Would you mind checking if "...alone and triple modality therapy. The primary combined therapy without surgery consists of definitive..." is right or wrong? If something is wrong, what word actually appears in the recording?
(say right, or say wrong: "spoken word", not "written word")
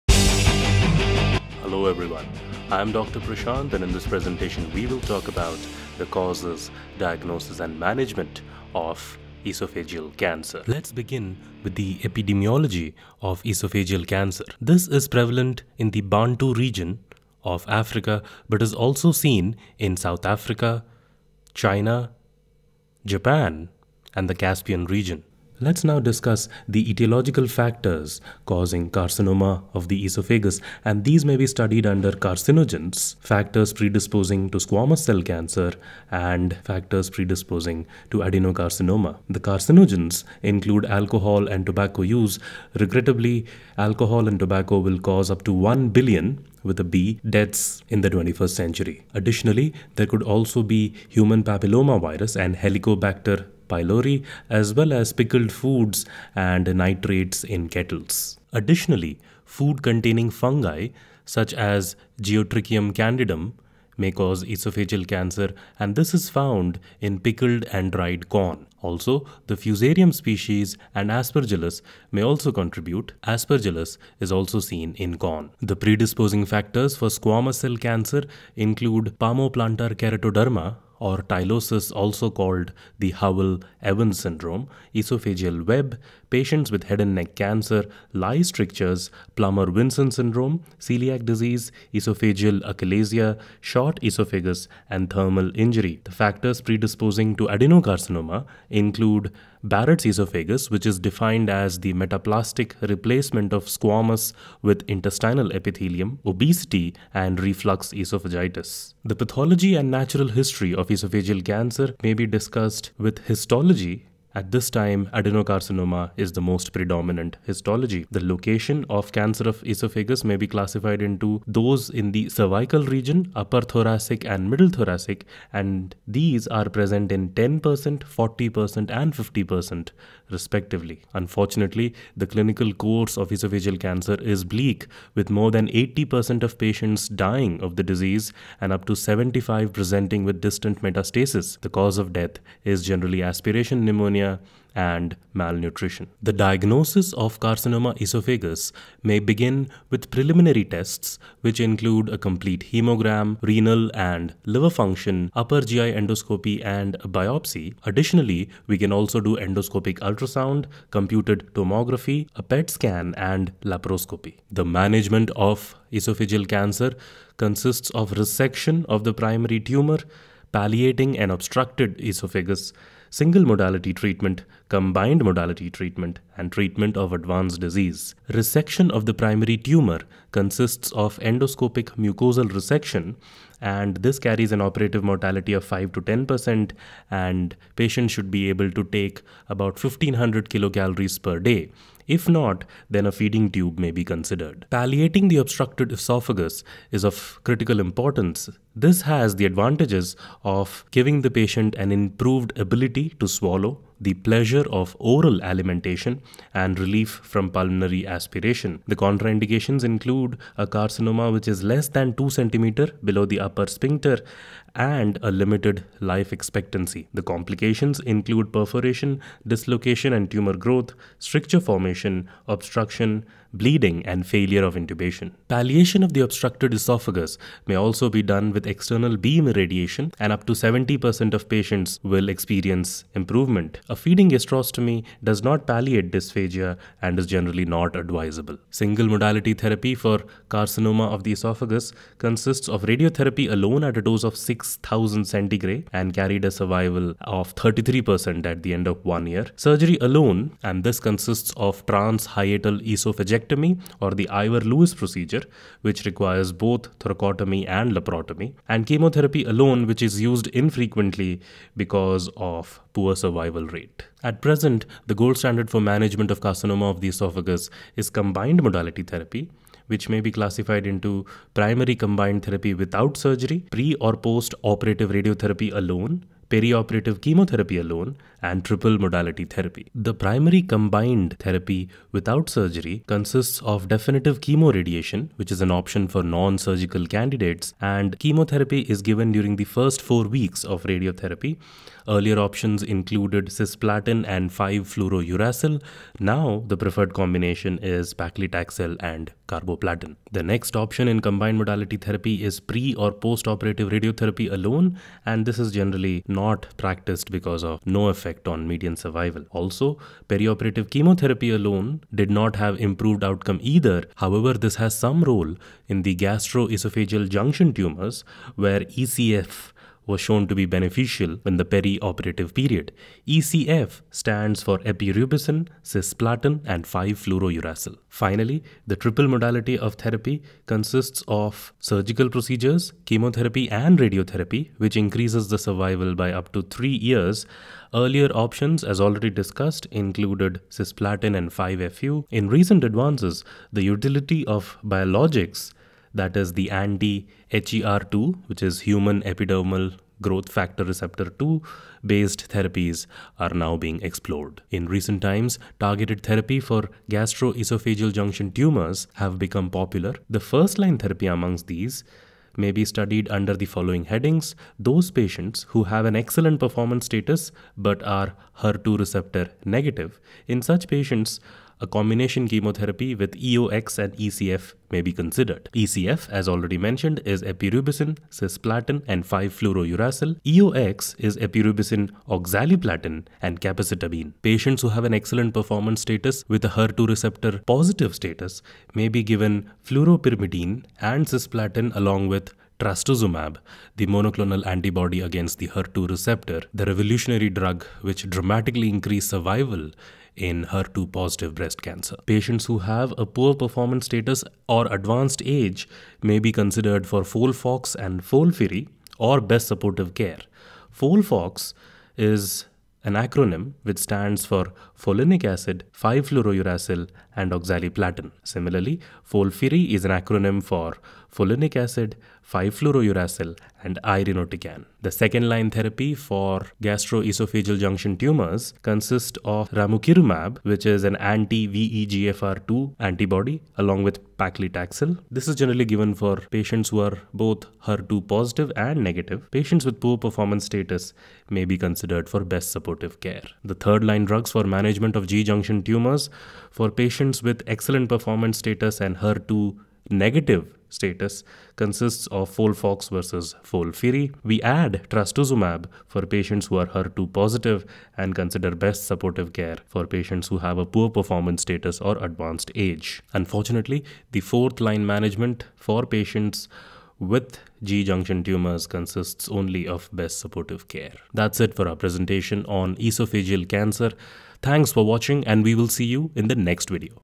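right.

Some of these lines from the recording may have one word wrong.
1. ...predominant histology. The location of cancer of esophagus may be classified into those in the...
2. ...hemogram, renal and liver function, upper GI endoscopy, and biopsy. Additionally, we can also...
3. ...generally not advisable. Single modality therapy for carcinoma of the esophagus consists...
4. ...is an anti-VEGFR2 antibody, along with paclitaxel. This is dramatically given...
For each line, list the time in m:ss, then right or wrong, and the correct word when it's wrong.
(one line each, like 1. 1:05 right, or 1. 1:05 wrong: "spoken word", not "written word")
1. 1:56 right
2. 2:32 right
3. 3:57 right
4. 7:10 wrong: "generally", not "dramatically".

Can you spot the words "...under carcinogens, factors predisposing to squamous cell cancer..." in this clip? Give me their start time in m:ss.
0:31.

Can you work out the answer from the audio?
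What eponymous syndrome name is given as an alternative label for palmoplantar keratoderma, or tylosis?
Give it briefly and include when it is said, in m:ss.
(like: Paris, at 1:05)
Howell Evans syndrome, at 1:23.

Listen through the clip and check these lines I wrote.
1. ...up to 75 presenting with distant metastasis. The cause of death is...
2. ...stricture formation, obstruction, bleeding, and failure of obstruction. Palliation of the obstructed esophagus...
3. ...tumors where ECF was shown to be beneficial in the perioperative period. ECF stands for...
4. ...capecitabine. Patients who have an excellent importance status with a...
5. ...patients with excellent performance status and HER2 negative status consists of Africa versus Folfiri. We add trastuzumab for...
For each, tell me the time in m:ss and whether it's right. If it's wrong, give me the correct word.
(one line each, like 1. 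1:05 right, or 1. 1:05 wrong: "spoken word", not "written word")
1. 2:18 right
2. 3:41 wrong: "intubation", not "obstruction"
3. 5:17 right
4. 6:23 wrong: "performance", not "importance"
5. 7:26 wrong: "Folfox", not "Africa".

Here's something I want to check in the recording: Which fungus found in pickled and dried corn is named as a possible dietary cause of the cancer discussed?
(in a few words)
Geotrichum candidum.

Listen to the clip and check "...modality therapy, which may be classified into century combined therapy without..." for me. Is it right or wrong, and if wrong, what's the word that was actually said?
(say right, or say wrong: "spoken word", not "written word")
wrong: "primary", not "century".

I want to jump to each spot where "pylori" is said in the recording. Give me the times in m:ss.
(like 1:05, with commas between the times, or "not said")
0:53.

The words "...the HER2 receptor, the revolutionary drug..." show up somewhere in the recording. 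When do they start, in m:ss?
6:35.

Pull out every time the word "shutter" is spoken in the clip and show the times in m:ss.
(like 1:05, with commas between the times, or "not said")
not said.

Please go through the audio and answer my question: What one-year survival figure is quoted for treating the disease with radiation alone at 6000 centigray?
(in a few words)
33%.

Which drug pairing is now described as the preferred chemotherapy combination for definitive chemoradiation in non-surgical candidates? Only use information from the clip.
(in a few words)
paclitaxel and carboplatin.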